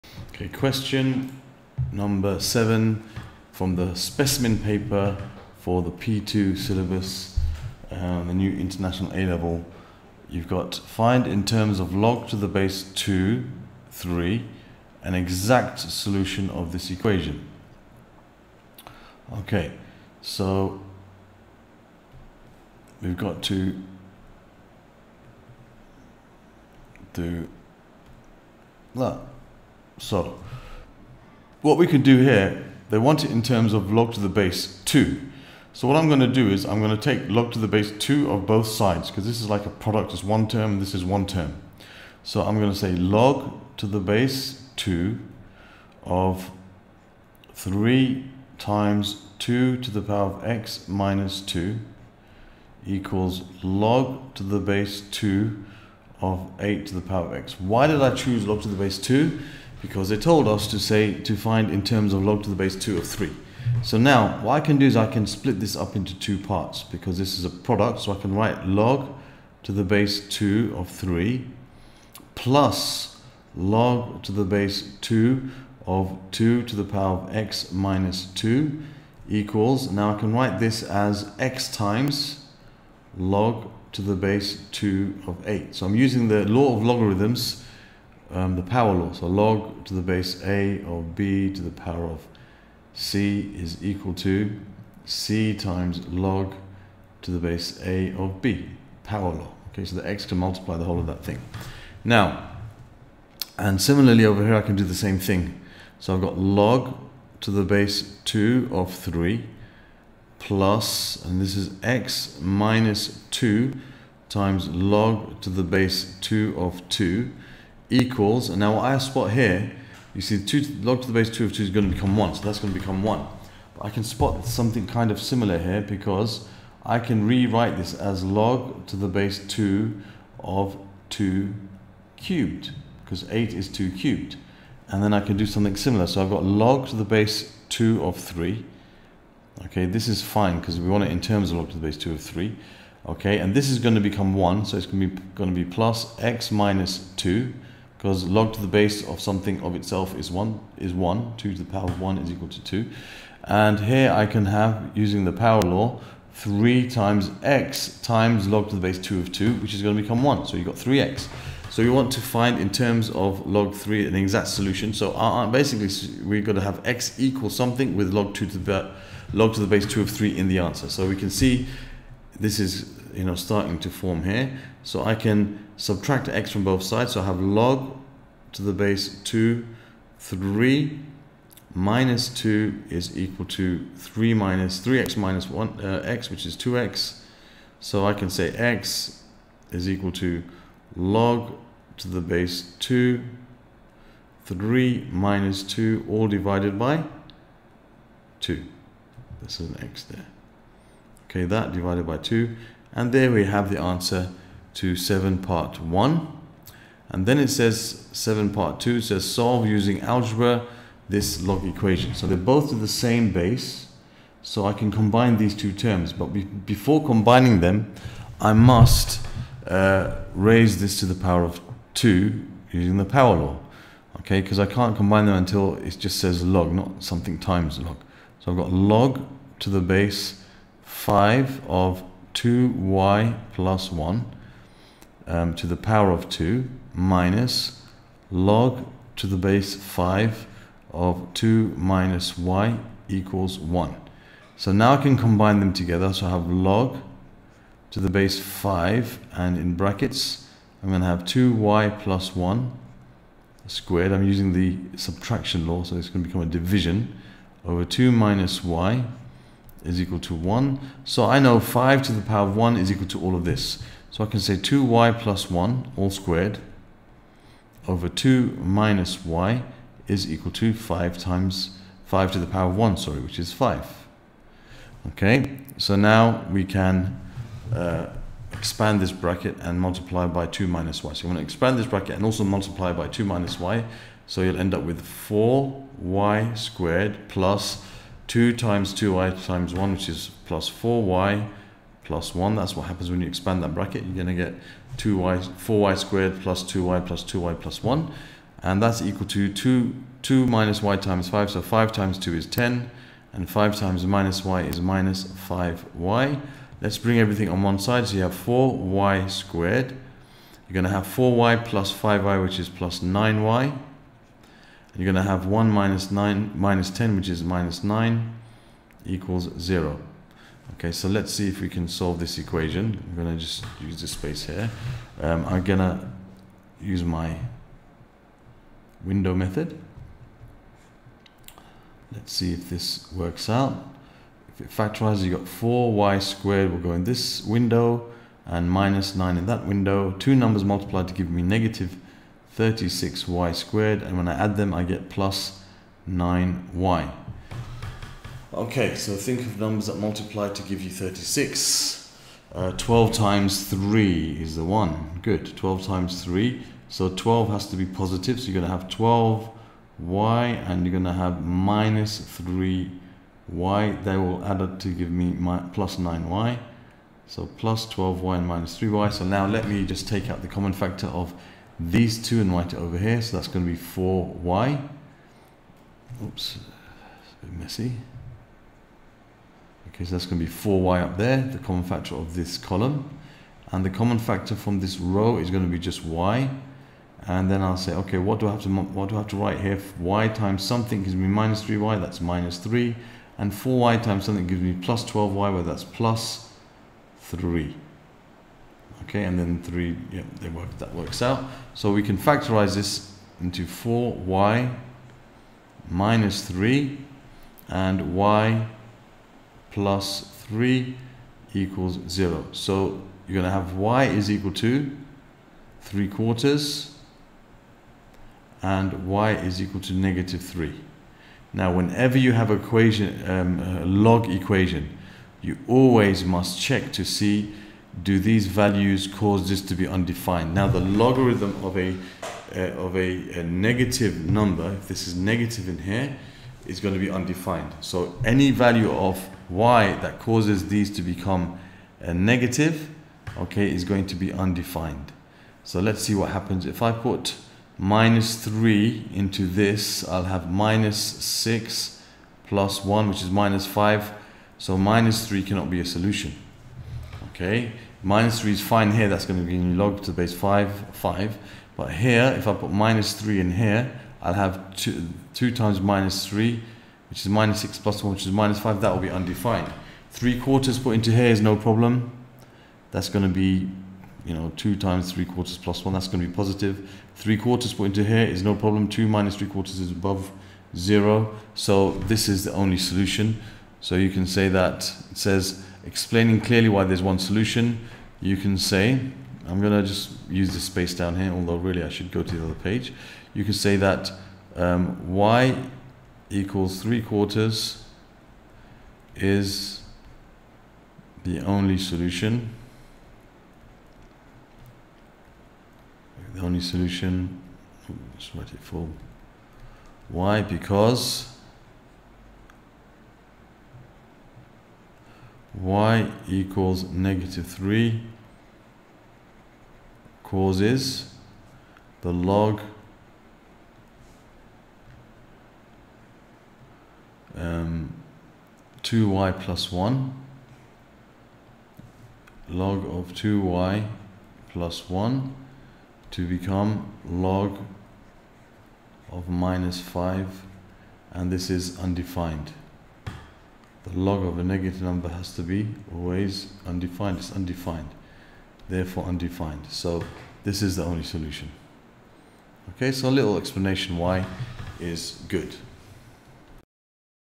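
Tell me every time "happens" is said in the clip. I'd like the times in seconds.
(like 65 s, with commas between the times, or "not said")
292 s, 446 s.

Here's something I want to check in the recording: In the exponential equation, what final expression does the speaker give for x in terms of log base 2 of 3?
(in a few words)
(log2 3 - 2)/2.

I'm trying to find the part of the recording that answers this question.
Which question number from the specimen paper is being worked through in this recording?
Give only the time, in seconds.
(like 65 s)
0 s.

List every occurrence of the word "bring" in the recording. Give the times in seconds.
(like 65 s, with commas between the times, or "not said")
306 s.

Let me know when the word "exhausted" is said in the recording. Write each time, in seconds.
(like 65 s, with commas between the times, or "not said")
not said.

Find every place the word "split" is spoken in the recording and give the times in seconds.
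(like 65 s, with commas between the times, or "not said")
65 s.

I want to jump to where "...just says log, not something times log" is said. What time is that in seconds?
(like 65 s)
225 s.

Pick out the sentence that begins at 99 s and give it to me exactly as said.
Okay, so the x to multiply the whole of that thing.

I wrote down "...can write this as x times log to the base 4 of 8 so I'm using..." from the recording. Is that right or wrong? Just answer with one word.
wrong.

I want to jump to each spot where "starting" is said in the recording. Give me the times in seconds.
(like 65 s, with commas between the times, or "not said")
173 s.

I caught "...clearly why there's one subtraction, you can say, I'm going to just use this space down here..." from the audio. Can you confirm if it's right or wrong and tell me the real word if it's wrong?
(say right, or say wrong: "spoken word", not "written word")
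wrong: "solution", not "subtraction".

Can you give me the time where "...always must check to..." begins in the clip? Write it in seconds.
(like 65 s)
425 s.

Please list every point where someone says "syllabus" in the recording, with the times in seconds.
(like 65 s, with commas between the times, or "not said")
6 s.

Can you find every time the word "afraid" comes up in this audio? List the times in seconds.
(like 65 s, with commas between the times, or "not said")
not said.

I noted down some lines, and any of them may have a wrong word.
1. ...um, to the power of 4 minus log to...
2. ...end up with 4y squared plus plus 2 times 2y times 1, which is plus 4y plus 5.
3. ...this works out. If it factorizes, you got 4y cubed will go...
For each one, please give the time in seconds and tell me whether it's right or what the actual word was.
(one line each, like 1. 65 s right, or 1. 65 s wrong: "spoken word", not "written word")
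1. 235 s wrong: "2", not "4"
2. 284 s wrong: "1", not "5"
3. 332 s wrong: "squared", not "cubed".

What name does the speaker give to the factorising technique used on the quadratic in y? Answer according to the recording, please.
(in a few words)
window method.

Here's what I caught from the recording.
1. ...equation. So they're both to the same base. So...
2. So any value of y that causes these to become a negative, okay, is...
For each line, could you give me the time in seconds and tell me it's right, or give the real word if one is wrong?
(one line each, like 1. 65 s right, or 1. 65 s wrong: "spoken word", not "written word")
1. 211 s right
2. 437 s right.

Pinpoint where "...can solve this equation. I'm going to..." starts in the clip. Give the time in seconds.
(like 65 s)
321 s.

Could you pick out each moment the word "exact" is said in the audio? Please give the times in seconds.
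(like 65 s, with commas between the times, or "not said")
15 s, 164 s.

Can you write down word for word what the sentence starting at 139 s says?
Okay, this is fine because we want it in terms of log to the base 2 of 3.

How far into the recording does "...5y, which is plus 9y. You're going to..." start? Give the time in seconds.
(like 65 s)
311 s.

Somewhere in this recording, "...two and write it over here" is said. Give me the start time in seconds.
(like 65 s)
372 s.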